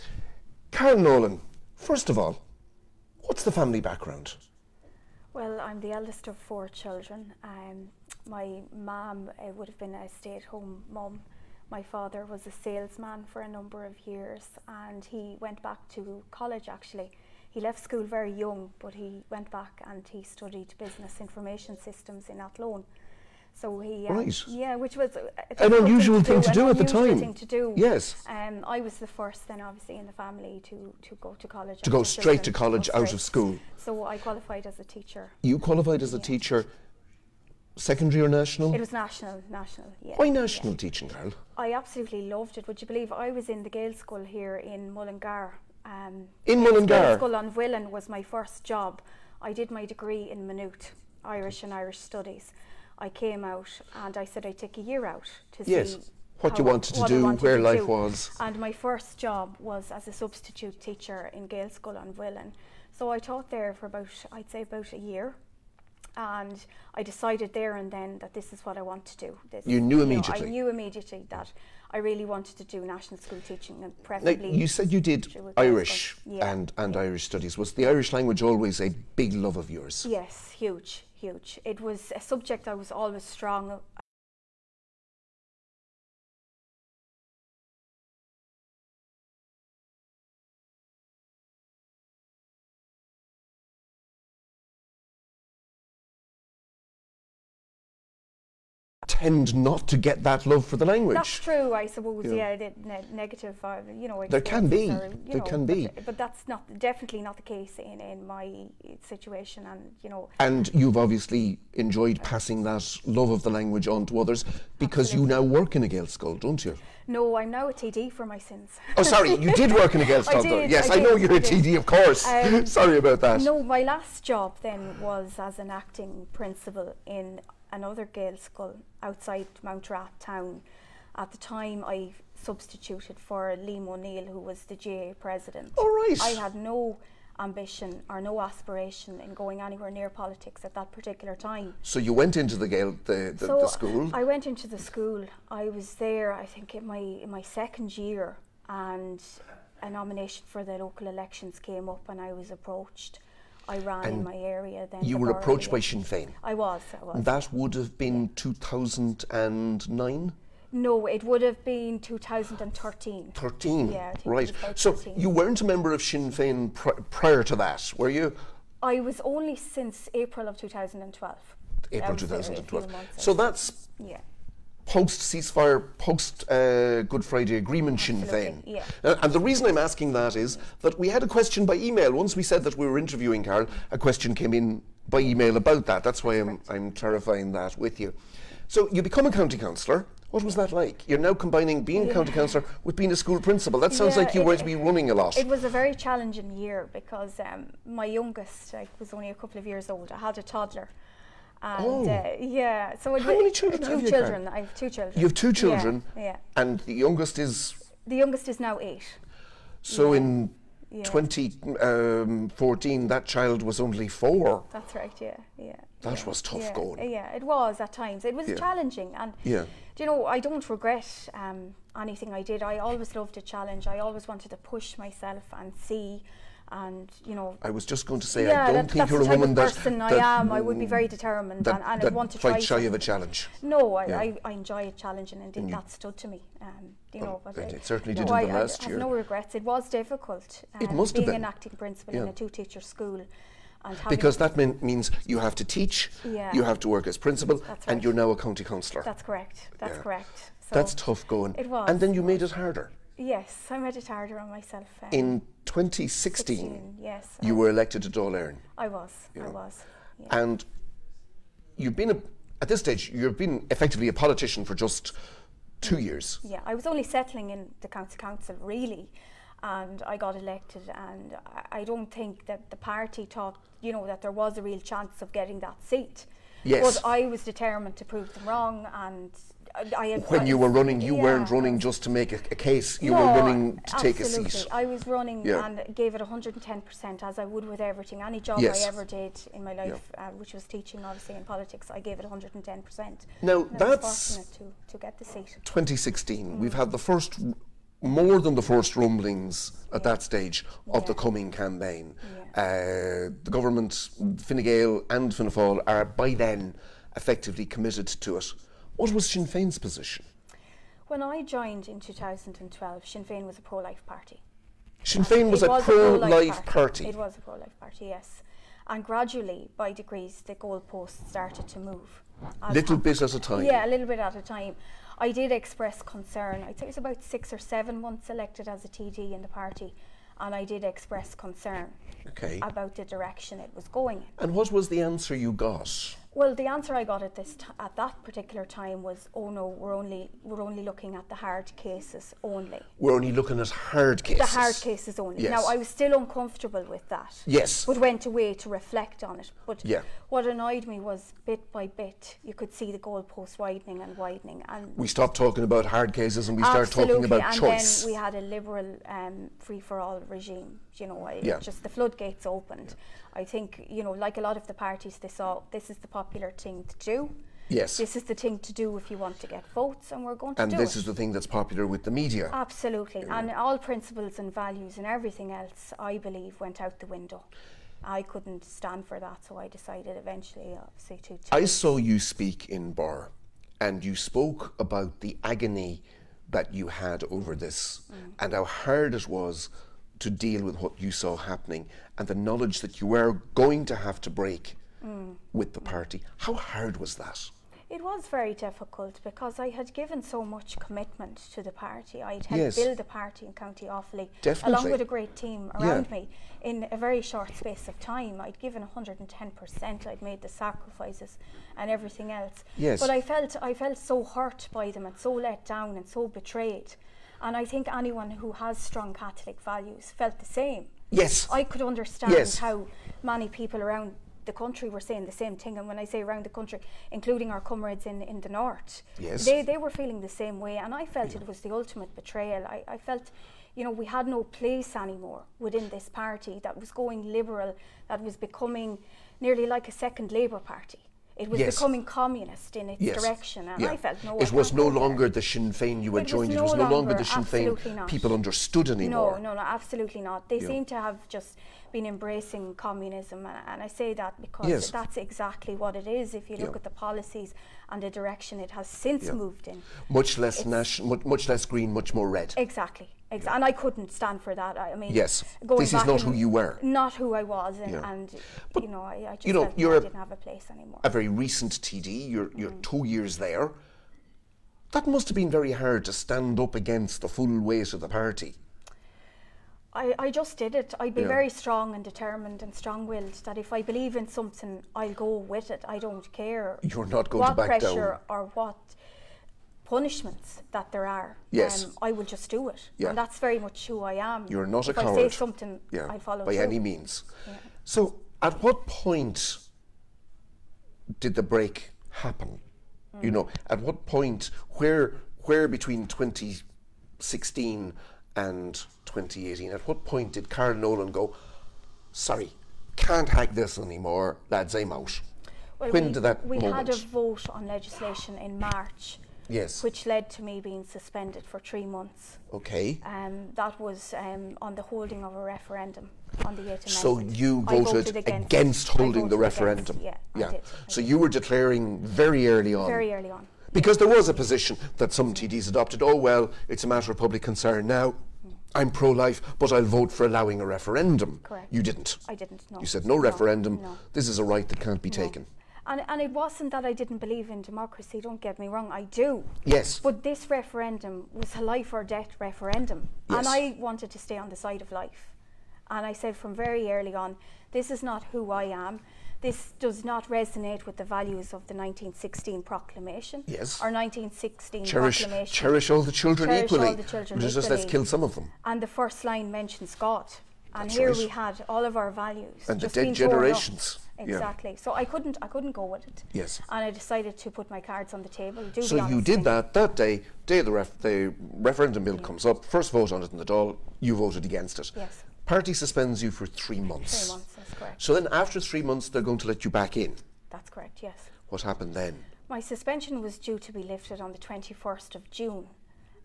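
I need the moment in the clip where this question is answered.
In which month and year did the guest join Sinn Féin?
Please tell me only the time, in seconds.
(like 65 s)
170 s.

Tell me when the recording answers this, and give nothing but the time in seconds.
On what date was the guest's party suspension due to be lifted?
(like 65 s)
594 s.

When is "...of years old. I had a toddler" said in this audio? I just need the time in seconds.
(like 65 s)
199 s.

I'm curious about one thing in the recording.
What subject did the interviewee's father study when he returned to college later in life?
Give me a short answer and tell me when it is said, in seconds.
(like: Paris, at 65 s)
Business information systems, at 20 s.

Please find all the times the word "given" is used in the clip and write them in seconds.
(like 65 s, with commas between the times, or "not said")
399 s, 408 s.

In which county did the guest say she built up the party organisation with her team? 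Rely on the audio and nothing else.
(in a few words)
Offaly.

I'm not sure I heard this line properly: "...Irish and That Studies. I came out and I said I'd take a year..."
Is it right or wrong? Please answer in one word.
wrong.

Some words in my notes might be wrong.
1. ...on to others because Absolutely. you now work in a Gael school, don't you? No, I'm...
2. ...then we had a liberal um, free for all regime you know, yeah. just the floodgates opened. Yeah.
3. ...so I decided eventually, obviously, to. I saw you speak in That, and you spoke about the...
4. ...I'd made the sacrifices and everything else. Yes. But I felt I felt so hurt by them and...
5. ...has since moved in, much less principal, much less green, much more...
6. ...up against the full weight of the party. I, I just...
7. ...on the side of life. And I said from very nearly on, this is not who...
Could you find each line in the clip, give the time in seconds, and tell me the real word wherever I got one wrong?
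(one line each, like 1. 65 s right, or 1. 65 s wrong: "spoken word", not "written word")
1. 113 s right
2. 358 s right
3. 379 s wrong: "Birr", not "That"
4. 410 s right
5. 458 s wrong: "national", not "principal"
6. 476 s right
7. 554 s wrong: "early", not "nearly".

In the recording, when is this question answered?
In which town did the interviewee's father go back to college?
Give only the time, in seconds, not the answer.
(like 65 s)
22 s.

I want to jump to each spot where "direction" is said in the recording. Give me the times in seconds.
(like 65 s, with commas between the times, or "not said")
333 s, 443 s, 458 s.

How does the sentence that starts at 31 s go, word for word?
To go straight to college out of school.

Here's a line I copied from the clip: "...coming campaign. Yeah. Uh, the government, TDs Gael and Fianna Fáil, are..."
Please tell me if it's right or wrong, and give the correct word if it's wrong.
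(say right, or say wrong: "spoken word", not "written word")
wrong: "Fine", not "TDs".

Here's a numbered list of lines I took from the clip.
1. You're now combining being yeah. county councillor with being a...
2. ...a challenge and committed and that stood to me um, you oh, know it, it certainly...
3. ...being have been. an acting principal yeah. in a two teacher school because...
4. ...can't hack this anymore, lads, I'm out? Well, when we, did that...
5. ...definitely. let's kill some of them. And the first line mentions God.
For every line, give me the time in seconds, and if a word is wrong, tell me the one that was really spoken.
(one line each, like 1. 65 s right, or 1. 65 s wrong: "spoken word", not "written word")
1. 191 s right
2. 234 s wrong: "indeed", not "committed"
3. 241 s right
4. 512 s right
5. 567 s wrong: "equally", not "definitely".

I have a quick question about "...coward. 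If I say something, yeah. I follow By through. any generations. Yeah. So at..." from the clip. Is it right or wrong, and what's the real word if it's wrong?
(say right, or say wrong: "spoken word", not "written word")
wrong: "means", not "generations".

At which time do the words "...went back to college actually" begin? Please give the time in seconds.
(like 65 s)
15 s.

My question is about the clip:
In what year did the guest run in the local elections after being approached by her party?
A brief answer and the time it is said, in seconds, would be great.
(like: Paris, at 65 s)
2013, at 161 s.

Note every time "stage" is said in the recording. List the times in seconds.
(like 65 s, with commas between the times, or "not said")
262 s, 300 s.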